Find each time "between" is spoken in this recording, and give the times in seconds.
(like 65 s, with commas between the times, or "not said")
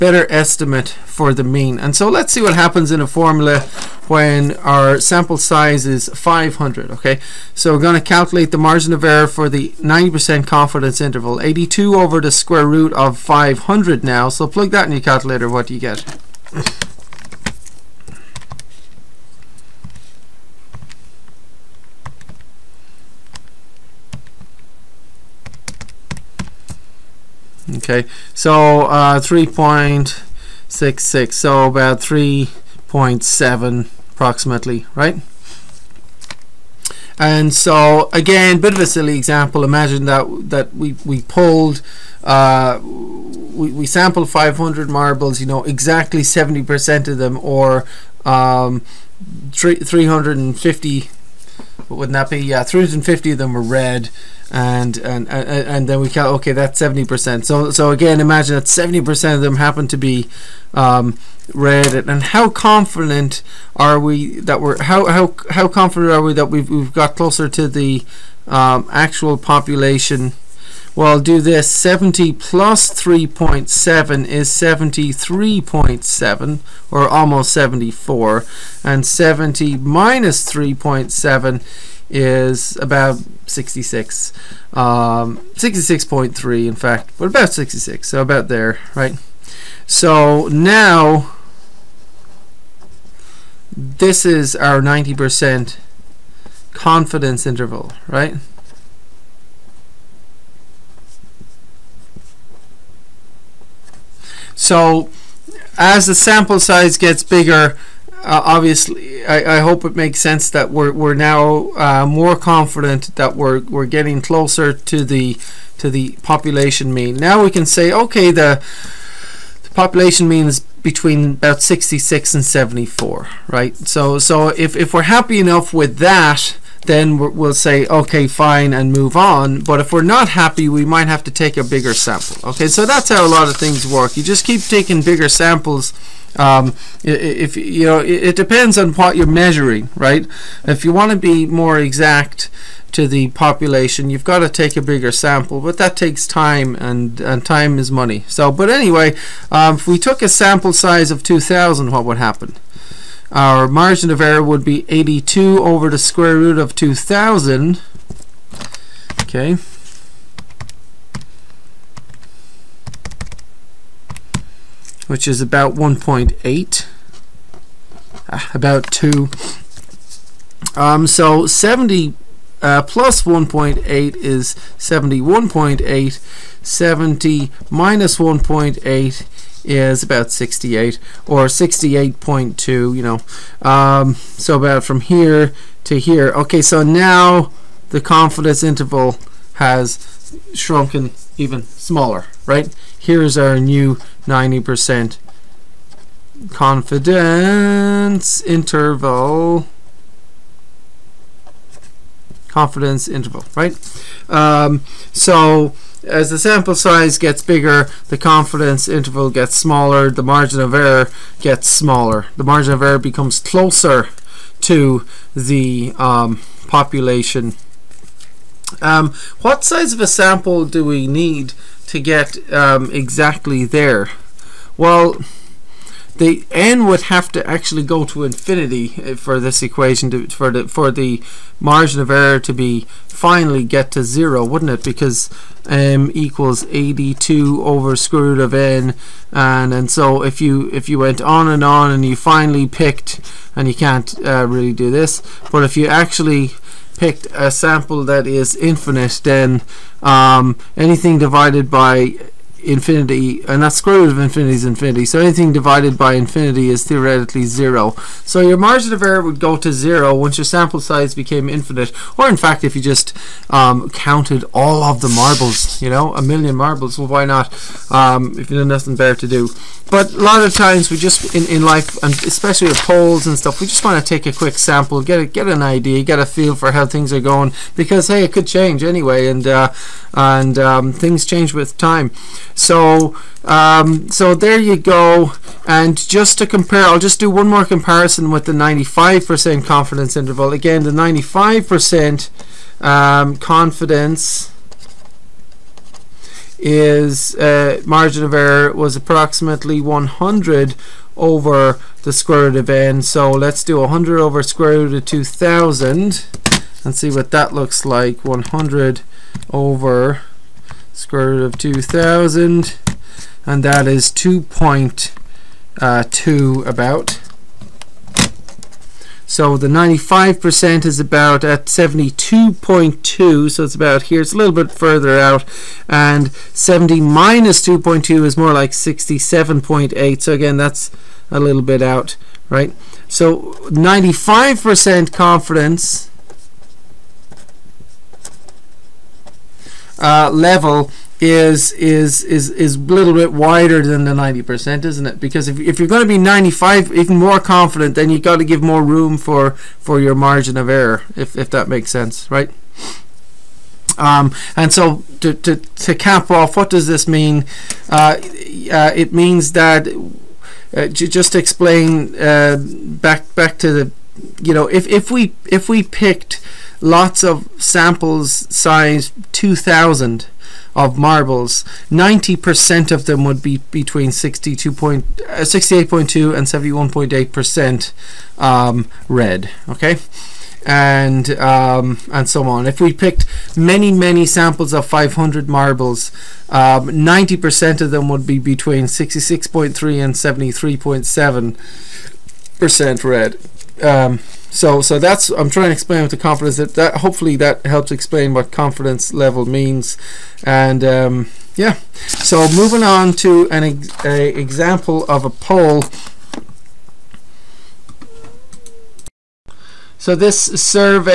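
120 s, 373 s, 388 s.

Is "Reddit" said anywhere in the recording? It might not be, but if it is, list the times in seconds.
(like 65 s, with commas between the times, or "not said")
61 s.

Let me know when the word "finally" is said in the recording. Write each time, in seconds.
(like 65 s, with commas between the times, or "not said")
233 s, 242 s.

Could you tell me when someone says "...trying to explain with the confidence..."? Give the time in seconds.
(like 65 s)
395 s.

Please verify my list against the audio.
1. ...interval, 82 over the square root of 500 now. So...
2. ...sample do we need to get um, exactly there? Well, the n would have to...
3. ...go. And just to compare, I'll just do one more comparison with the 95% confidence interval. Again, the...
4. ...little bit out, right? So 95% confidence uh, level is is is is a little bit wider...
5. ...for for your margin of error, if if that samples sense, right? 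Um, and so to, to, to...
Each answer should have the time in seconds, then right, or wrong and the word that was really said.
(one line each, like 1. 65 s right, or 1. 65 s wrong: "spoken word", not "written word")
1. 10 s right
2. 220 s right
3. 284 s right
4. 331 s right
5. 349 s wrong: "makes", not "samples".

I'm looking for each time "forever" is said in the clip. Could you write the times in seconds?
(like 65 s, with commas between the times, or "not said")
not said.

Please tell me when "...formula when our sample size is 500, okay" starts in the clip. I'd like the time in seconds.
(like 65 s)
3 s.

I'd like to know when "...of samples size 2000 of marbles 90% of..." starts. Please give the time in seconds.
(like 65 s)
367 s.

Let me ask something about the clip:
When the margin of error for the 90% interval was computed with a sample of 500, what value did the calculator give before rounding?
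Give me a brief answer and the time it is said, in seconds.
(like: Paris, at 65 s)
3.66, at 29 s.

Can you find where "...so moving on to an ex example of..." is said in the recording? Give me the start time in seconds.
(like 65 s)
402 s.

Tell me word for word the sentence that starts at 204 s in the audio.
Um, so as the sample size gets bigger, the confidence interval gets smaller, the margin of error gets smaller.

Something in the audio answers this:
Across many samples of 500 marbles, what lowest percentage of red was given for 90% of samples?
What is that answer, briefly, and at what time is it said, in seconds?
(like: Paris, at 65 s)
66.3, at 388 s.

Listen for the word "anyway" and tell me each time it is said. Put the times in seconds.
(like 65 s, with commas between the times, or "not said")
148 s, 278 s.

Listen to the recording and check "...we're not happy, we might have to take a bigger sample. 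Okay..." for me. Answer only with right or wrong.
right.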